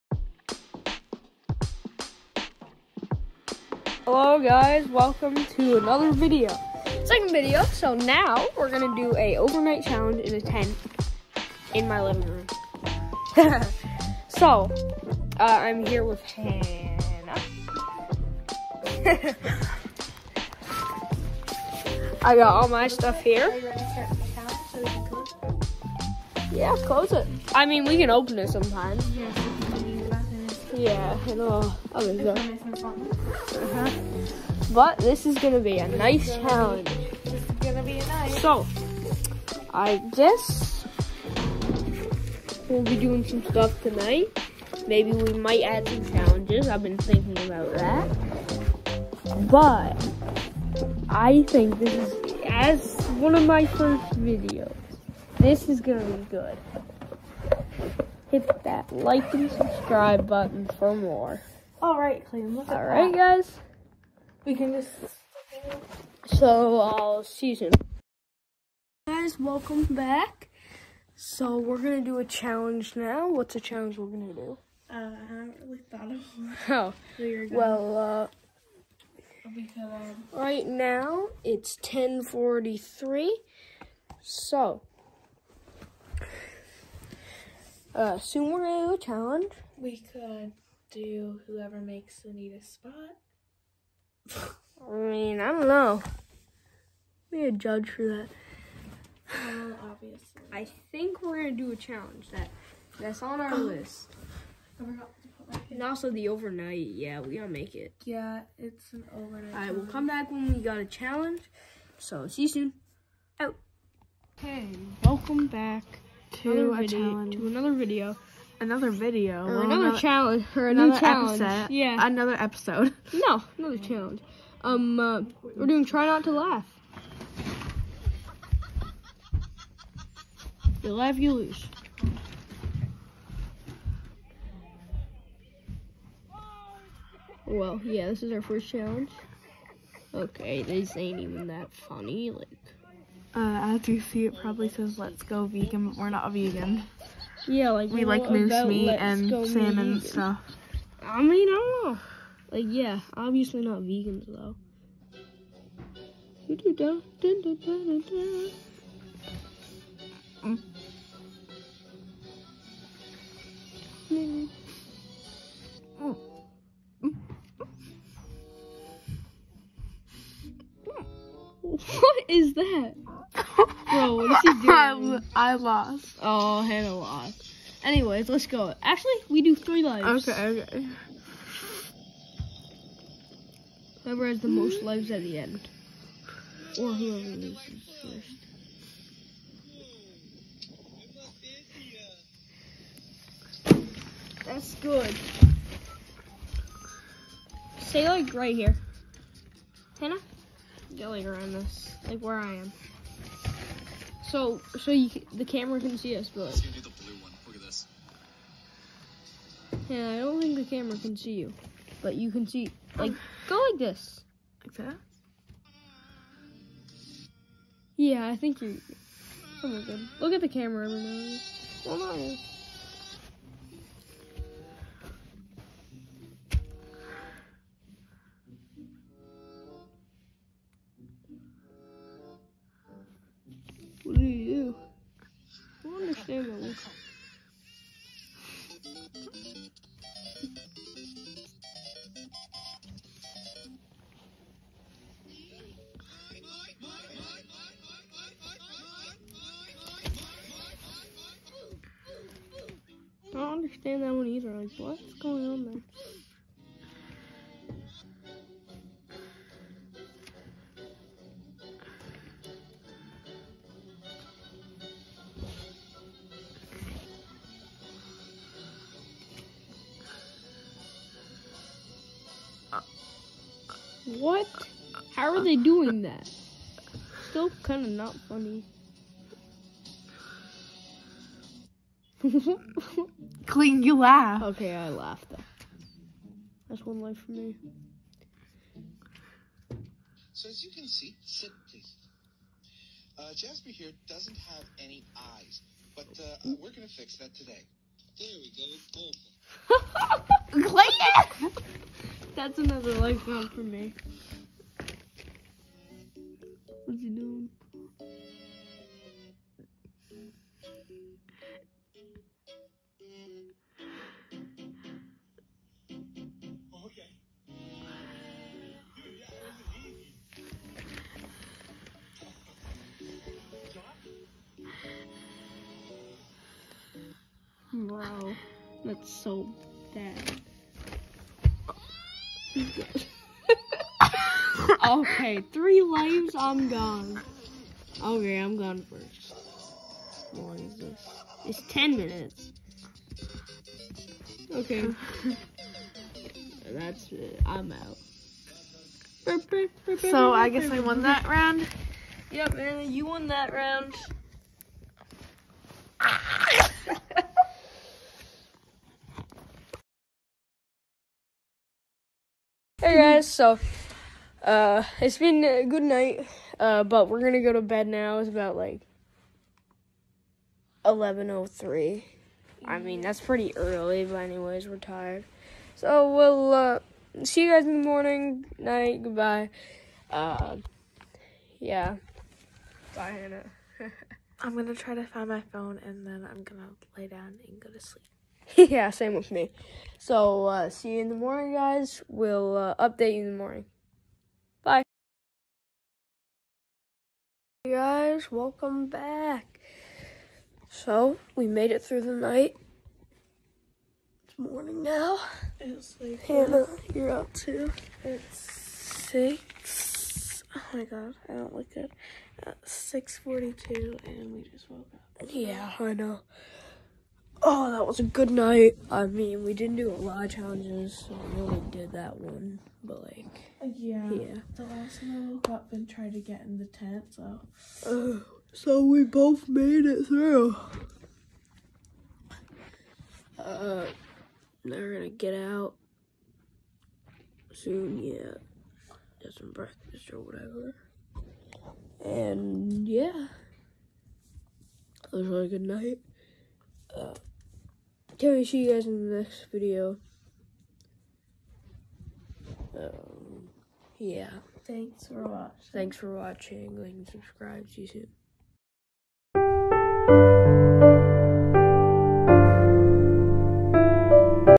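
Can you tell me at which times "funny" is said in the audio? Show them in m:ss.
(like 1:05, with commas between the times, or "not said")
2:21, 4:38.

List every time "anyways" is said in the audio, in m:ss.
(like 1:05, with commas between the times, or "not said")
2:57, 6:14.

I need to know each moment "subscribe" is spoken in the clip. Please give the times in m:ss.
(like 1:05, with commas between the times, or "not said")
0:59, 7:37.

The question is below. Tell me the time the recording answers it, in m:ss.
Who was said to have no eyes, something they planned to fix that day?
4:53.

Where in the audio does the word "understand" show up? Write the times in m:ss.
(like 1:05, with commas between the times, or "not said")
4:13.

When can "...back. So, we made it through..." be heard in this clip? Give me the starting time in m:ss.
6:38.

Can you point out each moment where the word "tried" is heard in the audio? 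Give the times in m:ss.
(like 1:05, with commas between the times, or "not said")
7:05.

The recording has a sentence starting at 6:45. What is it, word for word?
It's like Hannah, you're up too.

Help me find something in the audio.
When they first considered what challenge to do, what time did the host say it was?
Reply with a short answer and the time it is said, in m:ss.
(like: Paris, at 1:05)
10:43, at 1:21.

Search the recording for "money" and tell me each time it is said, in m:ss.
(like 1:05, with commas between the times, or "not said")
not said.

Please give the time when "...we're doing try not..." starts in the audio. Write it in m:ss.
2:05.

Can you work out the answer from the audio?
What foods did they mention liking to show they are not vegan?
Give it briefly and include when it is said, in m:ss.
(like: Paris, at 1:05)
Moose meat and salmon, at 2:28.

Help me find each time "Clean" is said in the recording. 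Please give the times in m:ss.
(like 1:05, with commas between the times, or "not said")
4:43, 5:00.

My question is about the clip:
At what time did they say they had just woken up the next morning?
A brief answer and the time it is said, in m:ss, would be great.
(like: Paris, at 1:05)
6:42, at 6:52.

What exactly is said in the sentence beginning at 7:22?
And yeah, it was a really good night.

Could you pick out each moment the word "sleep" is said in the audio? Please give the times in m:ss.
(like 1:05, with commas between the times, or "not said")
6:27.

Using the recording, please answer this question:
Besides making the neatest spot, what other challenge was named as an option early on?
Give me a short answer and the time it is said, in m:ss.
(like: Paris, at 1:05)
Sumo challenge, at 1:28.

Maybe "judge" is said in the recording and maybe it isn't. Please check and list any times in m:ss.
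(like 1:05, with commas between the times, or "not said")
1:37.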